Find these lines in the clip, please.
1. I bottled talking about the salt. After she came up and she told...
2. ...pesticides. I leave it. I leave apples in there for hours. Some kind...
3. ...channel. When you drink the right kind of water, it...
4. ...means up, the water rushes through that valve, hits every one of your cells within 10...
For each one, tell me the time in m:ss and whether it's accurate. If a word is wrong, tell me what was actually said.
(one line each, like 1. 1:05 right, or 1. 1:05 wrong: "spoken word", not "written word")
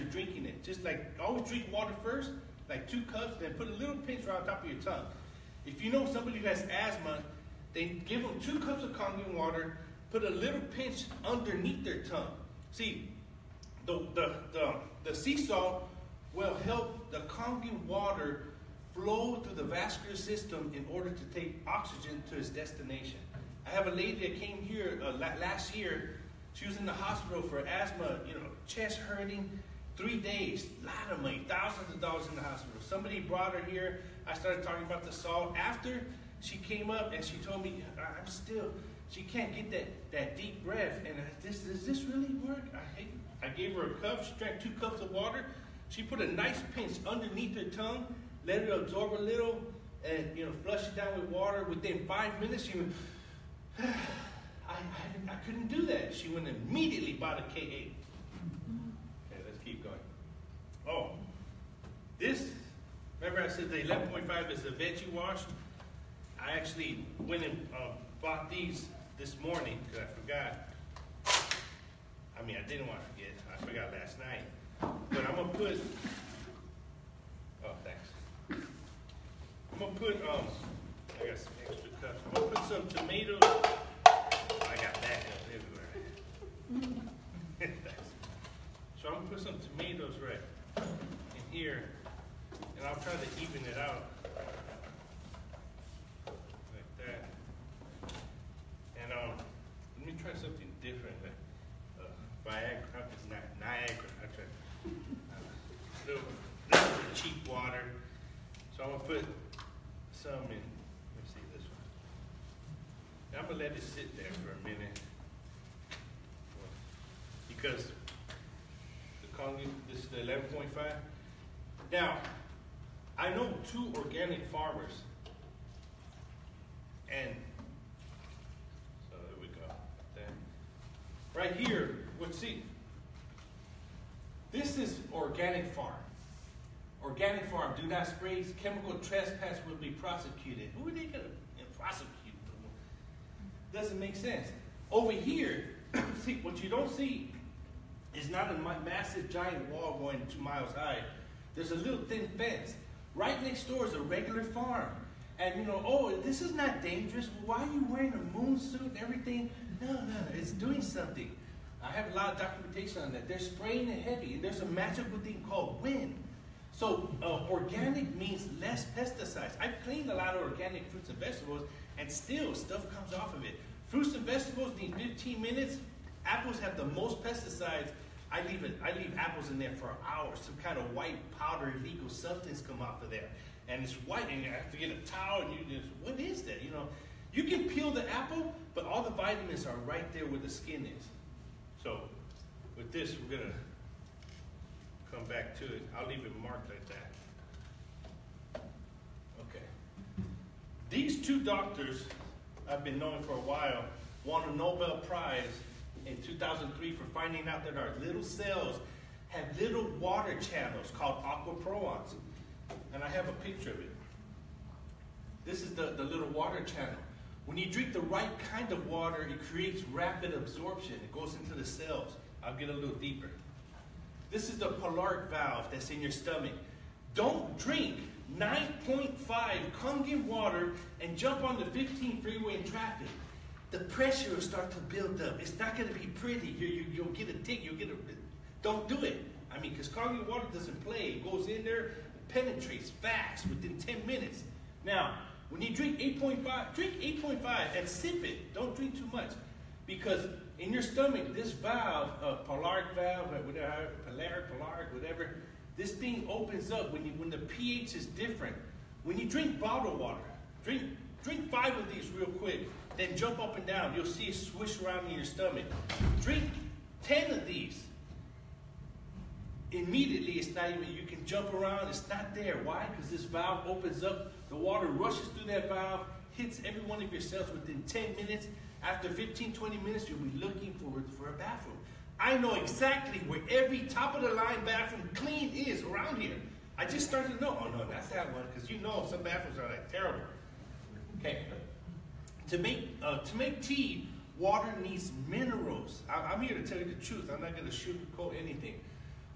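1. 0:34 wrong: "started", not "bottled"
2. 2:57 right
3. 3:36 right
4. 4:33 wrong: "opens", not "means".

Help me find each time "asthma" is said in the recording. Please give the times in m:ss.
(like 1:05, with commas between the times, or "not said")
0:06, 0:27.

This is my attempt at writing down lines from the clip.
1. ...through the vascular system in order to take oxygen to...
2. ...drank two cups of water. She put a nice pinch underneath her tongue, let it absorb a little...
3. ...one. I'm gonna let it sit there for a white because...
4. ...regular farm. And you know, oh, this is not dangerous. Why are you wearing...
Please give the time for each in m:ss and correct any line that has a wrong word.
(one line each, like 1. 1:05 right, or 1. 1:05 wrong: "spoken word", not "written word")
1. 0:19 right
2. 0:44 right
3. 1:51 wrong: "minute", not "white"
4. 2:34 right.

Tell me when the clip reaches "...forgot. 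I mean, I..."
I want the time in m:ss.
1:10.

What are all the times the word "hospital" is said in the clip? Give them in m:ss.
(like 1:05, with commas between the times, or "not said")
0:26, 0:32.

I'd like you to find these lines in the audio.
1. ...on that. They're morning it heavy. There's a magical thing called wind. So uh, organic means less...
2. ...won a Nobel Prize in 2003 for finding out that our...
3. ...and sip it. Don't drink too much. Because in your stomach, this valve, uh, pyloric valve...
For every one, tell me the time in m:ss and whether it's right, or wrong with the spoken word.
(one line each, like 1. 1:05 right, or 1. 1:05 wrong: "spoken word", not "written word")
1. 2:43 wrong: "spraying", not "morning"
2. 3:24 right
3. 4:07 right.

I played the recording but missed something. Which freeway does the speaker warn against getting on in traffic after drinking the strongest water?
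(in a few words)
15 freeway.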